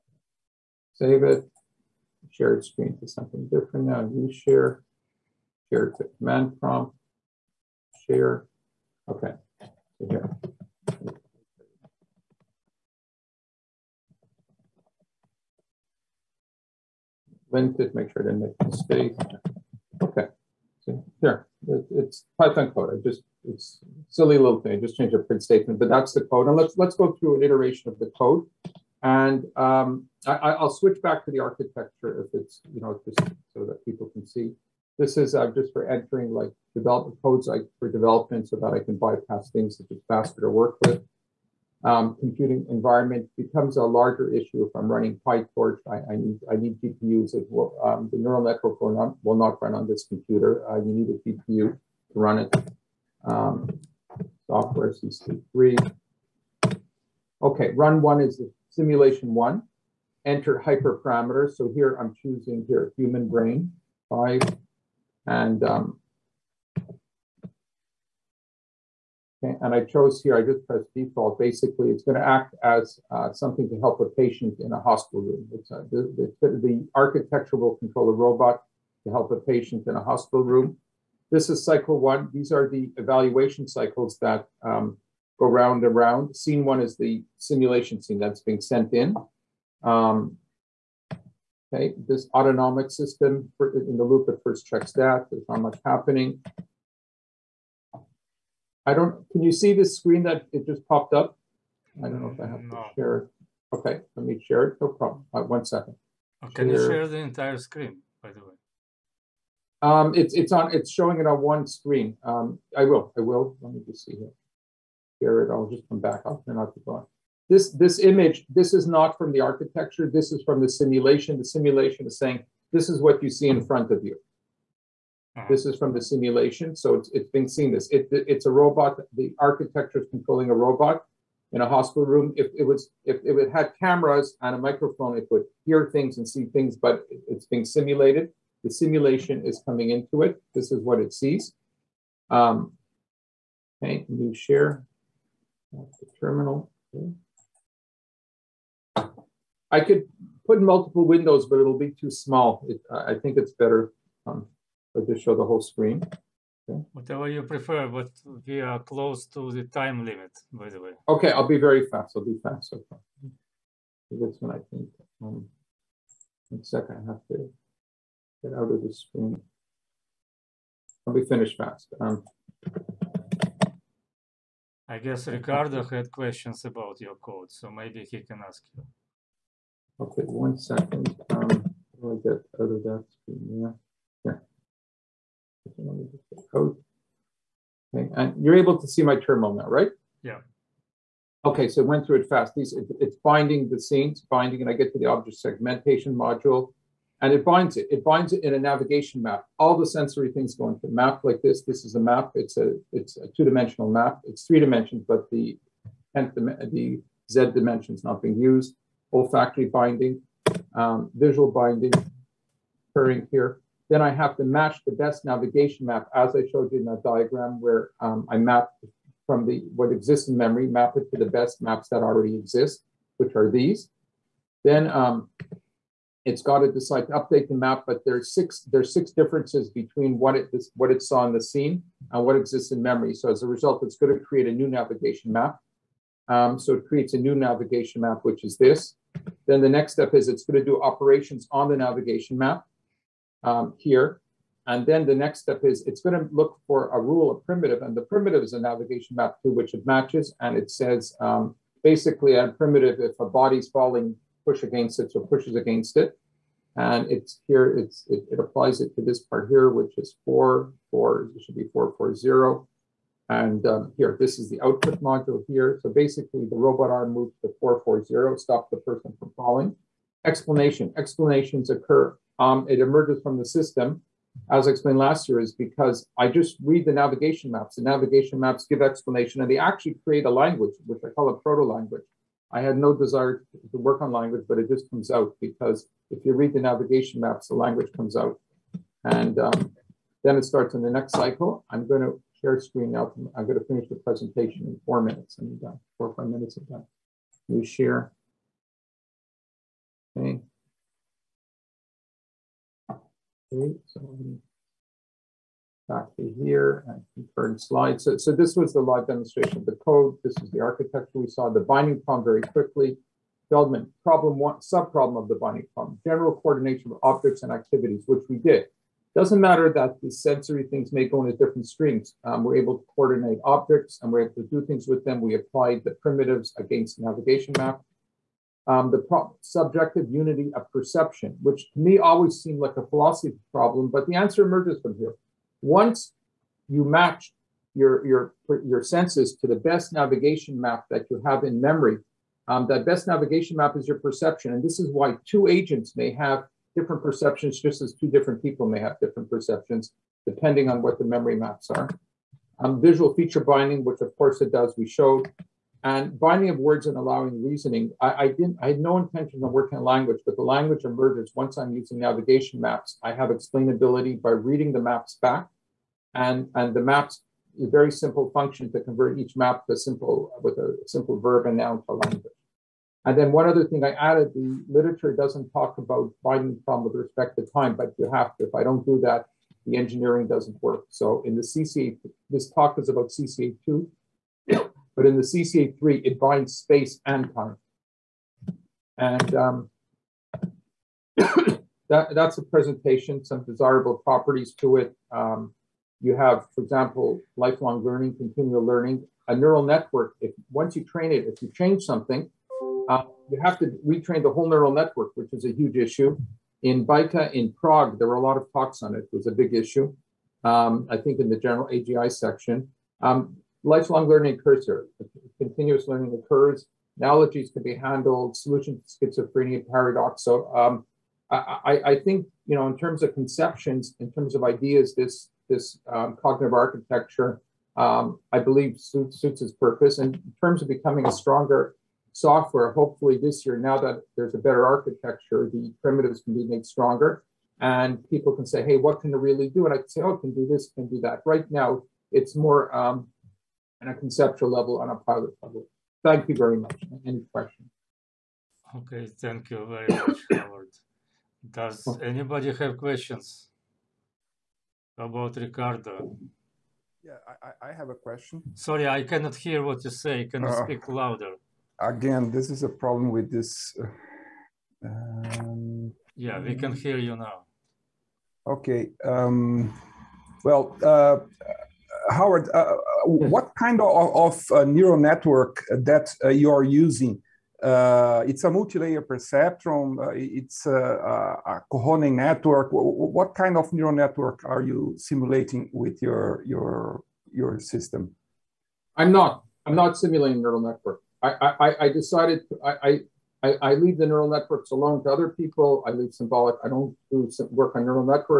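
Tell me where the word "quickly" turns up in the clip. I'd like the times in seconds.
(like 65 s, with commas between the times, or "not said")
312 s.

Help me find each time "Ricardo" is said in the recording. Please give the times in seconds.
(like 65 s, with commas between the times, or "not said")
175 s, 455 s.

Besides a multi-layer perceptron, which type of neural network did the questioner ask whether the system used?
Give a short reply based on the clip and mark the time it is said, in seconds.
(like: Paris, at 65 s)
Kohonen network, at 481 s.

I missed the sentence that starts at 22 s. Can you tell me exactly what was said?
I just, it's silly little thing, I just changed a print statement, but that's the code.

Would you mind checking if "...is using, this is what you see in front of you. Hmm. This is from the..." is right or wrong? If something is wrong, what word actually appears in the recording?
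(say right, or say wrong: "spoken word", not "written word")
wrong: "saying", not "using".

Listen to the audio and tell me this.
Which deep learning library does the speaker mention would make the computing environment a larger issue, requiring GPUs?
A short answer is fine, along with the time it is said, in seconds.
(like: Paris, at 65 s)
PyTorch, at 45 s.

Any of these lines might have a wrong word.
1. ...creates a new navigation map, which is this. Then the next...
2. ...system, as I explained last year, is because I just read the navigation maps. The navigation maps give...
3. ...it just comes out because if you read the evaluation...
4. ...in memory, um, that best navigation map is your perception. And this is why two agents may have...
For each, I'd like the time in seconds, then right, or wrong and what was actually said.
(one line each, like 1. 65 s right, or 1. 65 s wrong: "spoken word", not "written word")
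1. 236 s right
2. 273 s right
3. 284 s wrong: "navigation", not "evaluation"
4. 341 s right.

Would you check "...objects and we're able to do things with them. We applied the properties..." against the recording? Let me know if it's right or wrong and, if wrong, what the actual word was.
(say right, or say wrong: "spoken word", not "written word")
wrong: "primitives", not "properties".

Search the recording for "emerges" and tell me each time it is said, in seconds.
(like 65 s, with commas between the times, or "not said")
272 s, 334 s, 360 s.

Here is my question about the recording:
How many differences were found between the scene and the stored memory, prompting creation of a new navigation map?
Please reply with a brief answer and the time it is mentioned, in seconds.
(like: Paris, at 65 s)
6, at 228 s.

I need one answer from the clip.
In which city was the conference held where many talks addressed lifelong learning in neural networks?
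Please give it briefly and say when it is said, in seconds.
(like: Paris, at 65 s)
Prague, at 407 s.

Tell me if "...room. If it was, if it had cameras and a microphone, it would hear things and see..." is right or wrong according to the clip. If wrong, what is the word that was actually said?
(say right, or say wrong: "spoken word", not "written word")
right.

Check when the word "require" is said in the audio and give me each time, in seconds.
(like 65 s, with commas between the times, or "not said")
not said.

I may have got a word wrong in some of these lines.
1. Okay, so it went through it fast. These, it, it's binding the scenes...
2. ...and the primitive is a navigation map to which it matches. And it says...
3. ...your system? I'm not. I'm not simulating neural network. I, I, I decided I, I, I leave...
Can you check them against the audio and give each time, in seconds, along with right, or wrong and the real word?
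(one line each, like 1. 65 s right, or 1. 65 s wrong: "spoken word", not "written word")
1. 191 s right
2. 247 s right
3. 487 s right.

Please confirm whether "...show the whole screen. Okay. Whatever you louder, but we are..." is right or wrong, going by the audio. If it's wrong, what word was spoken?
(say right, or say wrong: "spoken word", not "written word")
wrong: "prefer", not "louder".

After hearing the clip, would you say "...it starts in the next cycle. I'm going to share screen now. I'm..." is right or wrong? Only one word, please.
right.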